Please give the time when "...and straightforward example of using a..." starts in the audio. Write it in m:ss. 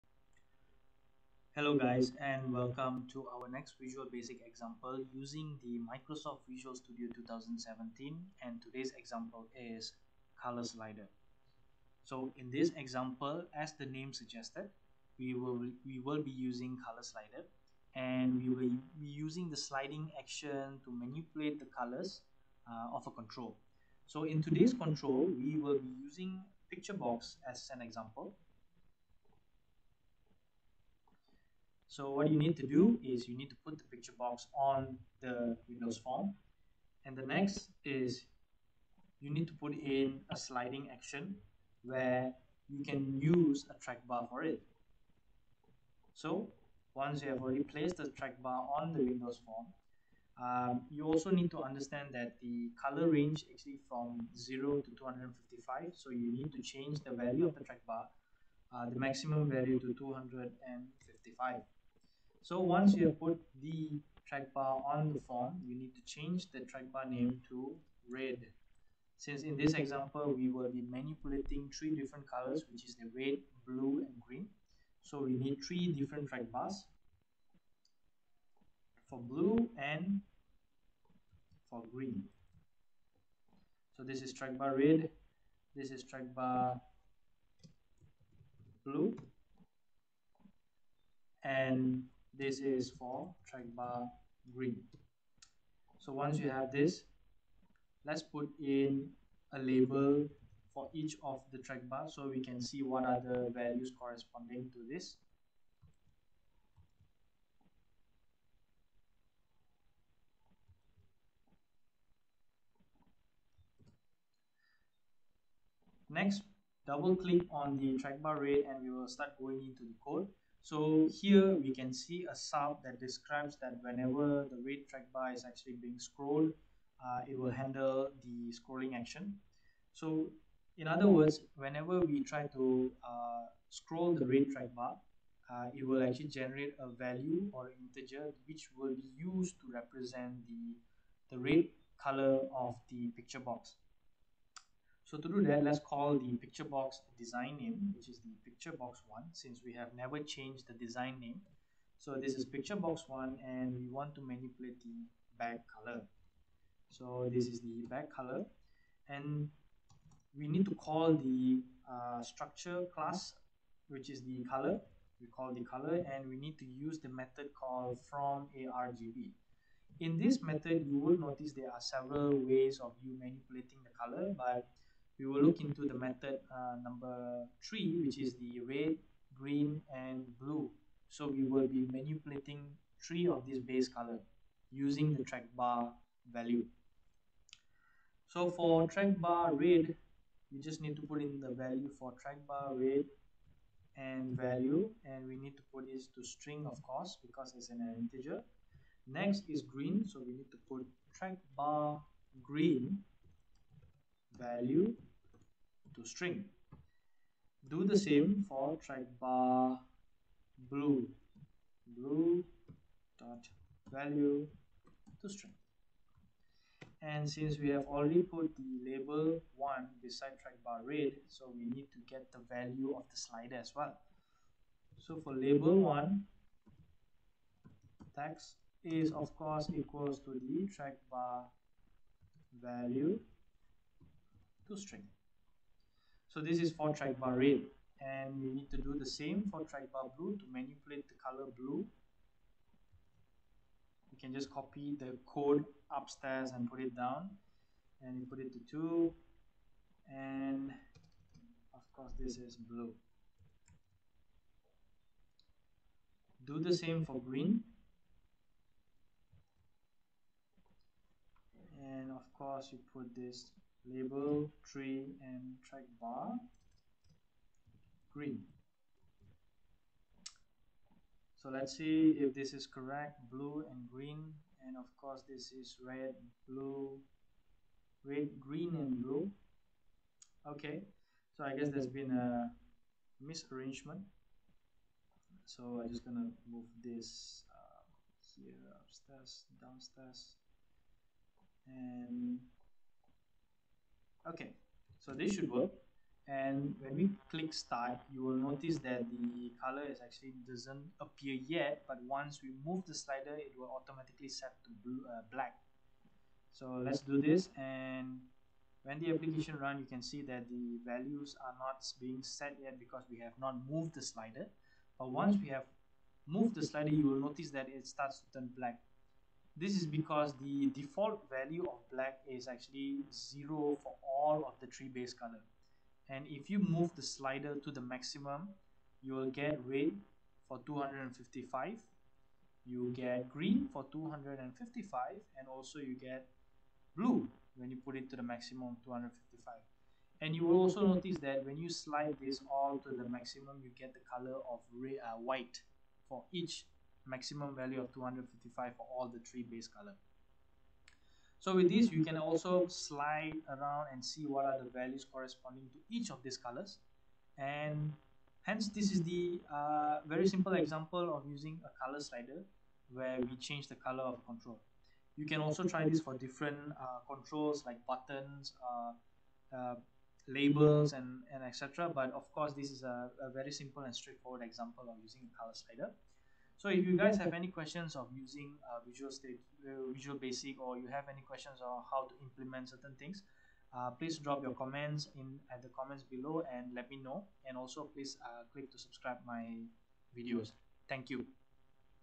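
6:13.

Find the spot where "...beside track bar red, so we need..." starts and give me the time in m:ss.
3:40.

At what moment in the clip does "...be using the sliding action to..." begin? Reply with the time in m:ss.
0:18.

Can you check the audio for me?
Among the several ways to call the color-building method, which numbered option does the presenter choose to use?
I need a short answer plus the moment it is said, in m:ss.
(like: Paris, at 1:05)
Number three, at 2:56.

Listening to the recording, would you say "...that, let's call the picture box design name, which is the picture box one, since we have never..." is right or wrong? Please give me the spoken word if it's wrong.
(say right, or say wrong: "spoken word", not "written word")
right.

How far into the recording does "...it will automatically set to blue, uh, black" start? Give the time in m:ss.
5:03.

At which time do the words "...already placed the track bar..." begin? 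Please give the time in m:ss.
0:47.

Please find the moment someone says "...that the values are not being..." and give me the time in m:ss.
5:10.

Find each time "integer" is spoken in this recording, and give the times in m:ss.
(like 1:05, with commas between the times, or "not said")
2:17, 3:17.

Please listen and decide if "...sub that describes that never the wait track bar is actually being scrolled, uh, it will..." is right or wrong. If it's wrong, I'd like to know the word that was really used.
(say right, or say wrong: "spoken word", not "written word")
wrong: "whenever", not "never".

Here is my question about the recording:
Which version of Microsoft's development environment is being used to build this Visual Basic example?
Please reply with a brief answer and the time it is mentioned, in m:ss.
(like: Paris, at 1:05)
Visual Studio 2017, at 0:05.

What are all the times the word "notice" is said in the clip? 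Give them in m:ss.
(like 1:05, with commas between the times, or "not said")
2:51, 4:58, 5:17, 5:40.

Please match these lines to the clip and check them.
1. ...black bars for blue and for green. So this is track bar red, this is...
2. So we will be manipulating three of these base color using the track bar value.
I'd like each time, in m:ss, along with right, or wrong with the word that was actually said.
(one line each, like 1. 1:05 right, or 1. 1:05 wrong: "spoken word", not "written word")
1. 1:16 wrong: "track", not "black"
2. 3:01 right.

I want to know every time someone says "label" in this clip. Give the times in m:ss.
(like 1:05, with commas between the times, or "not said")
1:39, 3:38, 3:45, 4:23, 6:10.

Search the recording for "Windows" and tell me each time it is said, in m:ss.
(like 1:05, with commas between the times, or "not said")
0:35, 0:49.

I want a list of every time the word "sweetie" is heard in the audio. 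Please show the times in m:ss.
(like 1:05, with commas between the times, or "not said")
not said.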